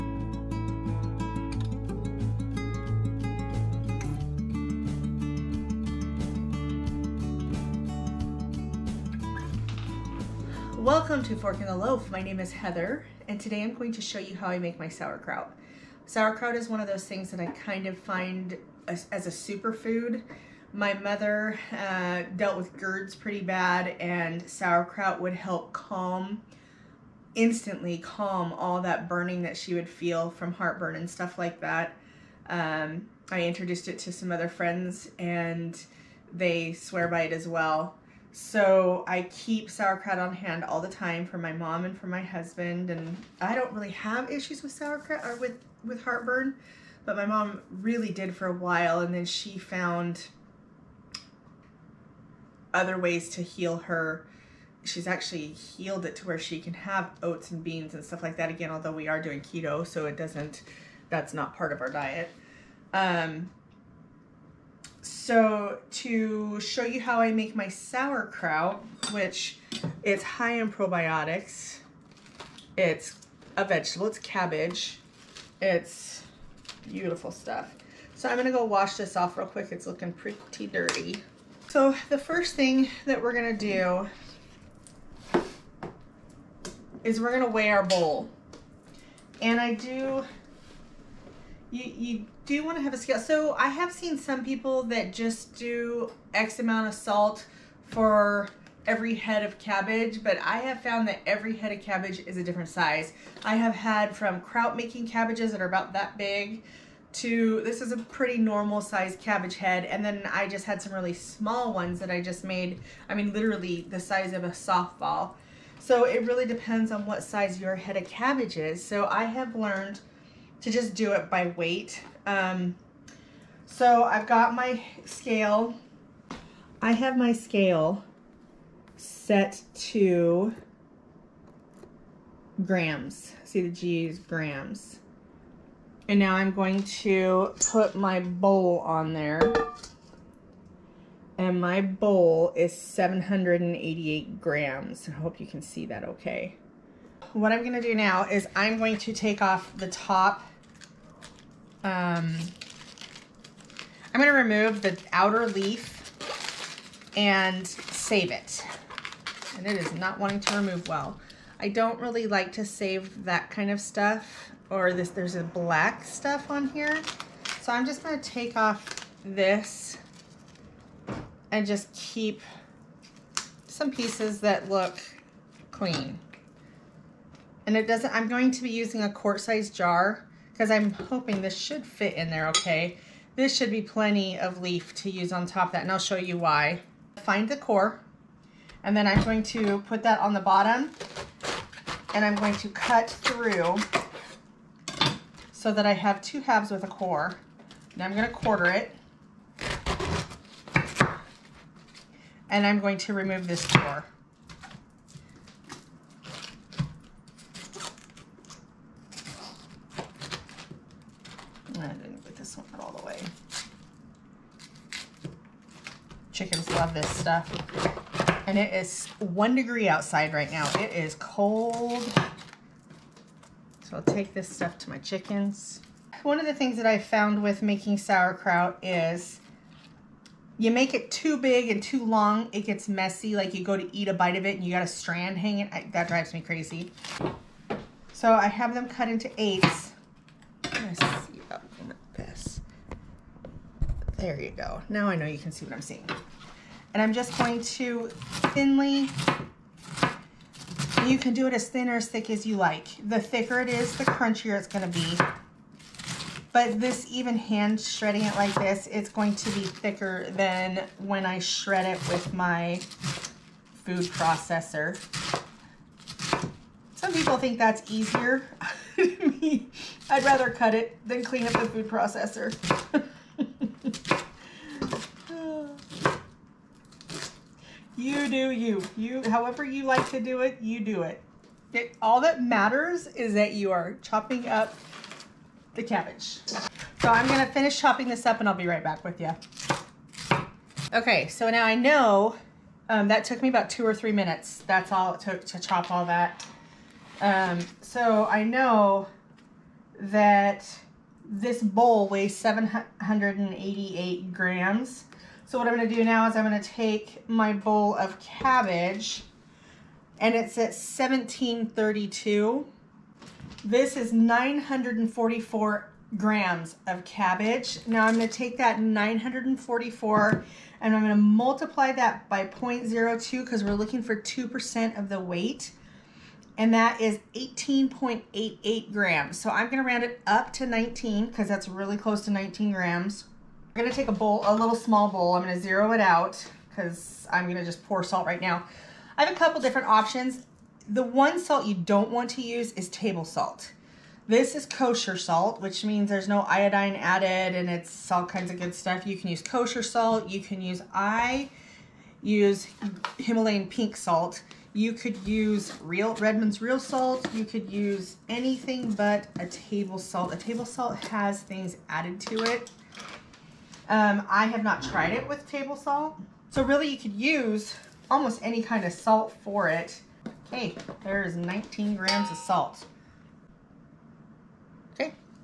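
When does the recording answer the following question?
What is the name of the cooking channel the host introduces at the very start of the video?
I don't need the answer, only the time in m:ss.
0:11.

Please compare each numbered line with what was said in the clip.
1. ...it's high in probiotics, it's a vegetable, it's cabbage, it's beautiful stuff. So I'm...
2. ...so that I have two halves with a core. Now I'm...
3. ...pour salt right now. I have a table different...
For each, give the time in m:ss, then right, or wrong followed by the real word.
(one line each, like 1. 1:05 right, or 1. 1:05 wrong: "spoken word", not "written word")
1. 1:10 right
2. 3:15 right
3. 5:37 wrong: "couple", not "table".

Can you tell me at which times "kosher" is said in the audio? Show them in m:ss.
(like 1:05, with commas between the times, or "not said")
5:44, 5:49.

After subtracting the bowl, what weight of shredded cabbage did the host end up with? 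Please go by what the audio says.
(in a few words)
944 grams.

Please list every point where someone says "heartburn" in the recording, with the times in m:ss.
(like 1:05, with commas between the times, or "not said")
0:30, 0:46.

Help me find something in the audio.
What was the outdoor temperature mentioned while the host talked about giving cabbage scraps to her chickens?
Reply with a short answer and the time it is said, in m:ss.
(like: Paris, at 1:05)
one degree, at 3:39.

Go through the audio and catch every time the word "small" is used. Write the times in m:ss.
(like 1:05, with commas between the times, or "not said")
1:51, 5:34.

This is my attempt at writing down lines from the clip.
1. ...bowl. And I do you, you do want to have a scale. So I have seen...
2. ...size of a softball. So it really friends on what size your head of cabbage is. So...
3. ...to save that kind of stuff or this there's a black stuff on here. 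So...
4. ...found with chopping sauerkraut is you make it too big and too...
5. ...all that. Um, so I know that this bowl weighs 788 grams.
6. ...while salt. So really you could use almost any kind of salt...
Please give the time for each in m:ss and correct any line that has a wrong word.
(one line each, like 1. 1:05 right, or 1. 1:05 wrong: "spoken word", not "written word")
1. 1:27 right
2. 1:54 wrong: "depends", not "friends"
3. 2:42 right
4. 3:46 wrong: "making", not "chopping"
5. 4:55 right
6. 6:05 wrong: "table", not "while".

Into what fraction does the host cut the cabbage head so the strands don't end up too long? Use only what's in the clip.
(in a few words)
eighths.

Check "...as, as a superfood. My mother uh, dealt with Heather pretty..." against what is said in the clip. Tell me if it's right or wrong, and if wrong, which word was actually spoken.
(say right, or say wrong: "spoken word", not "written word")
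wrong: "GERDs", not "Heather".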